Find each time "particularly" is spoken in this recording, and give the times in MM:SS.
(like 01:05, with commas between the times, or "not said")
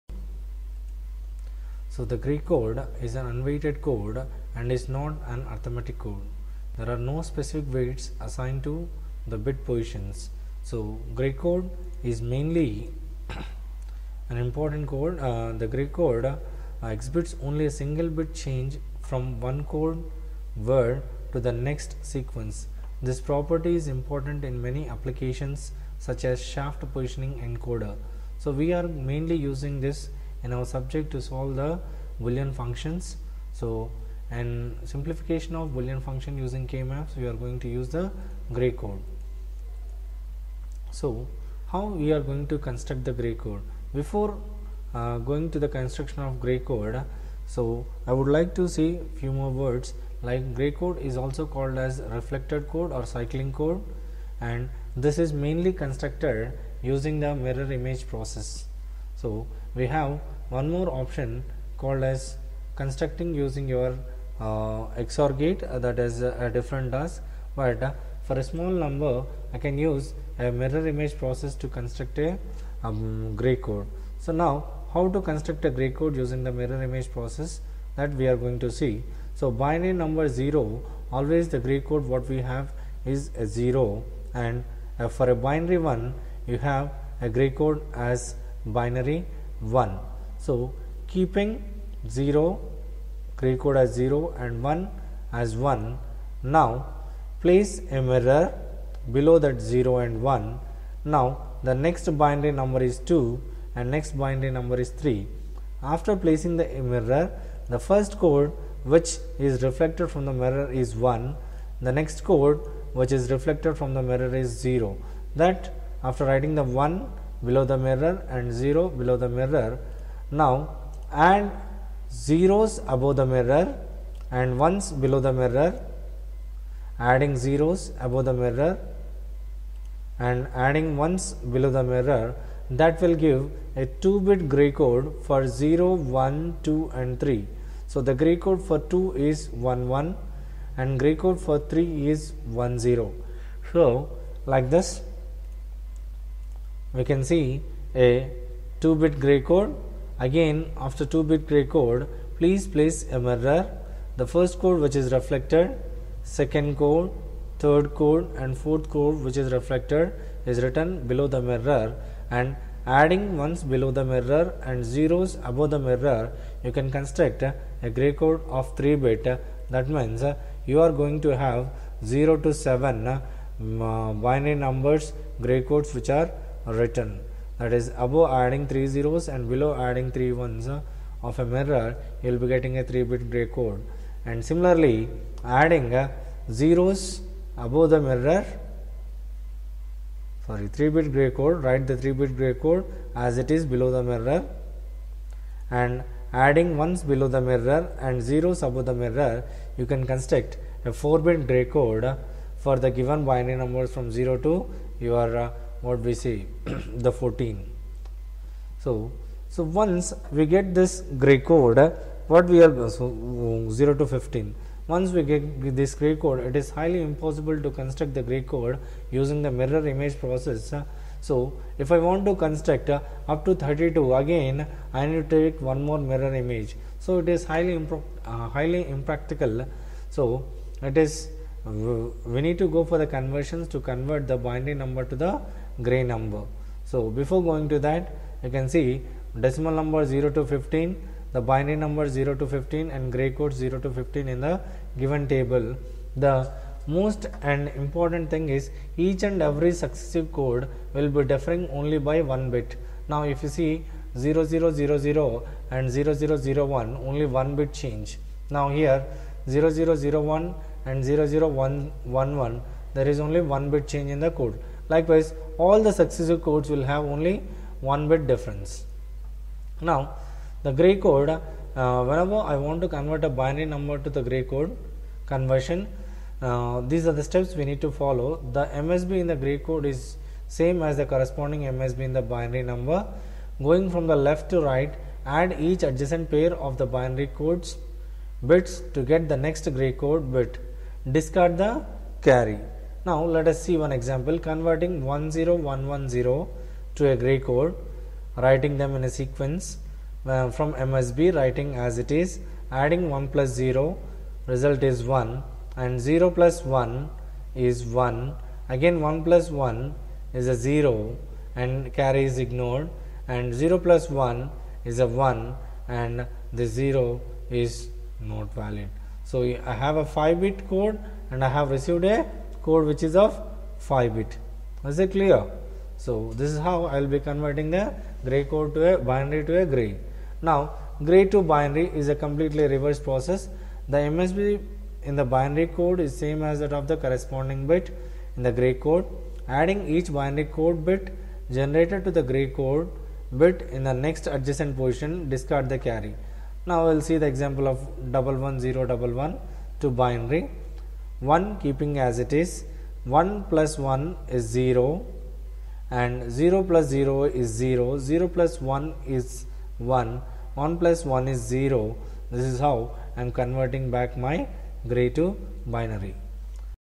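not said.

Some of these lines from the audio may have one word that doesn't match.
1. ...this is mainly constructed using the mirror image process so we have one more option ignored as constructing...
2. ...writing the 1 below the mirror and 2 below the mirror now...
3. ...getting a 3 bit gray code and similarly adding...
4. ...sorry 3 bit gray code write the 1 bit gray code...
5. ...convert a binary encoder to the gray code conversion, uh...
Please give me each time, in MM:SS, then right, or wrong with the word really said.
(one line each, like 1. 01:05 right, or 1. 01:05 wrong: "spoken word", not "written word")
1. 00:54 wrong: "called", not "ignored"
2. 01:56 wrong: "0", not "2"
3. 03:02 right
4. 03:10 wrong: "3", not "1"
5. 04:32 wrong: "number", not "encoder".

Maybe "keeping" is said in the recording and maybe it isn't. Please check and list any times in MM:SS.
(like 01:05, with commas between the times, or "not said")
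01:31, 05:51.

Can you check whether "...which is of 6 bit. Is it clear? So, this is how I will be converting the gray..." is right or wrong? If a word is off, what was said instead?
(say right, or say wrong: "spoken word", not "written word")
wrong: "5", not "6".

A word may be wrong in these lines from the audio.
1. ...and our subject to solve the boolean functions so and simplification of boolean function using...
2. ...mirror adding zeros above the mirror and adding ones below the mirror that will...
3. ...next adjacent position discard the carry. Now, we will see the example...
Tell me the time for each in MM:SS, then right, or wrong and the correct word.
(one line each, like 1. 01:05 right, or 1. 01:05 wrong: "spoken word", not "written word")
1. 00:30 right
2. 02:05 right
3. 05:43 right.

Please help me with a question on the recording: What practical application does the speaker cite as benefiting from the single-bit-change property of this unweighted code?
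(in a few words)
shaft positioning encoder.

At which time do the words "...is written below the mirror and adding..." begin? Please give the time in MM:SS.
02:40.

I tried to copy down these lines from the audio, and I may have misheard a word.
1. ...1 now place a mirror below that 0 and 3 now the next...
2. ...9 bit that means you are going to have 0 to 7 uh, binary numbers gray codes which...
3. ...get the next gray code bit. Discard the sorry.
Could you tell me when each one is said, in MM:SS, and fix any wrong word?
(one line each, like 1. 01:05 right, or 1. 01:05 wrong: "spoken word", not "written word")
1. 01:35 wrong: "1", not "3"
2. 02:48 wrong: "3", not "9"
3. 04:49 wrong: "carry", not "sorry".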